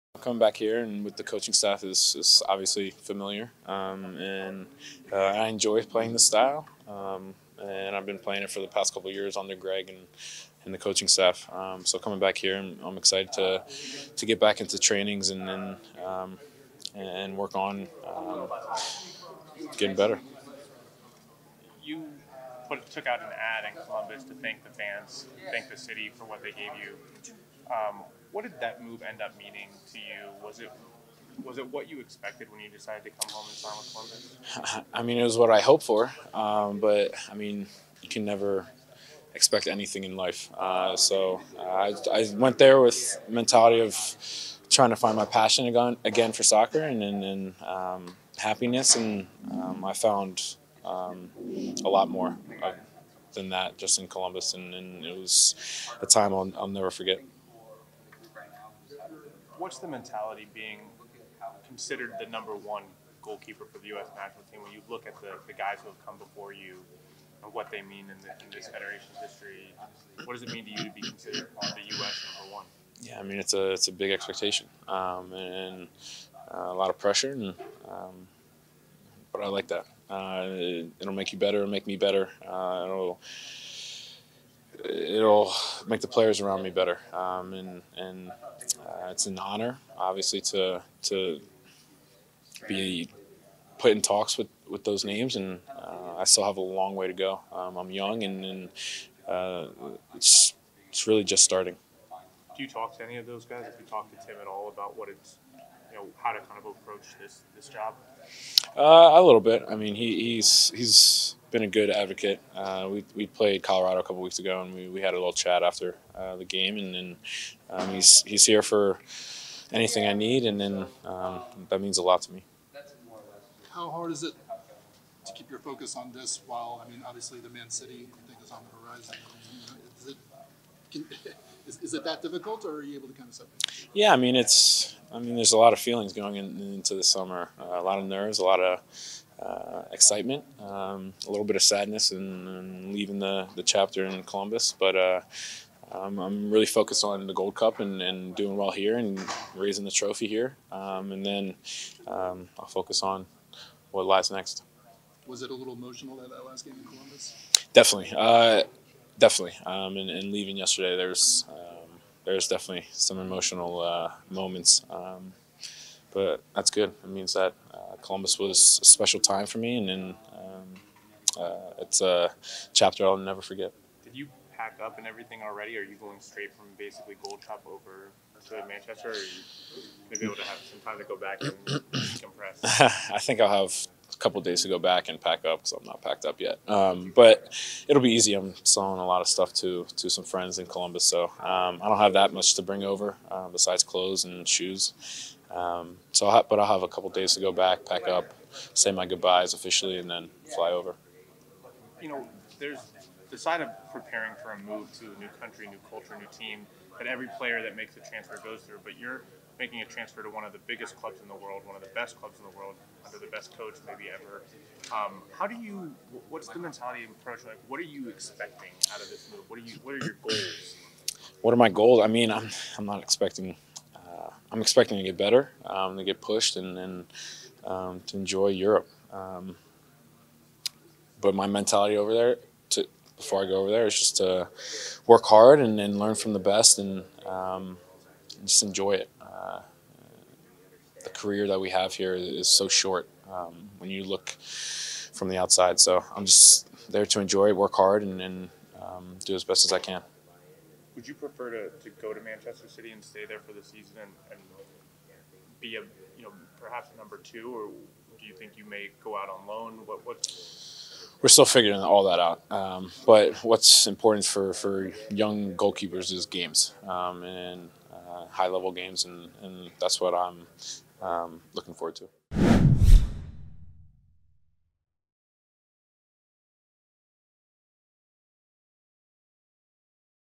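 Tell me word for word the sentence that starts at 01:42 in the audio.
Do you talk to any of those guys?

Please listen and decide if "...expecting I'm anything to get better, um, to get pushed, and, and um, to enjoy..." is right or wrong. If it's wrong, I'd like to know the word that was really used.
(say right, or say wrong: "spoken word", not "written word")
wrong: "expecting", not "anything".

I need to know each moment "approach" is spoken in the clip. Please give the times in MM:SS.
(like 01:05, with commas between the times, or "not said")
01:46, 03:37.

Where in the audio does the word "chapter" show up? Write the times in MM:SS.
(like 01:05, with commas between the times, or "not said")
02:23, 02:52.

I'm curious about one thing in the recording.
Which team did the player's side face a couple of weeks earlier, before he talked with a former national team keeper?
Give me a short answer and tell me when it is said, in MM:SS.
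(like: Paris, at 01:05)
Colorado, at 01:53.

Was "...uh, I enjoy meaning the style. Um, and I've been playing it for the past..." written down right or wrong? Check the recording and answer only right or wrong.
wrong.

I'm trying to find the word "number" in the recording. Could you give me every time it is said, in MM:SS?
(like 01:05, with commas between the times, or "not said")
01:02, 01:12, 04:16.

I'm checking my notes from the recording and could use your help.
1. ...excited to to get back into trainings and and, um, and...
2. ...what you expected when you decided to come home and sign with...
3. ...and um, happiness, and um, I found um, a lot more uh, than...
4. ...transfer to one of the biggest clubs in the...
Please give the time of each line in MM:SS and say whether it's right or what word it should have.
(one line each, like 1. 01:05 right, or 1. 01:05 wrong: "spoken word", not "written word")
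1. 00:12 right
2. 00:31 right
3. 00:47 right
4. 03:29 right.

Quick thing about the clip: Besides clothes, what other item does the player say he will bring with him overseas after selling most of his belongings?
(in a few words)
Shoes.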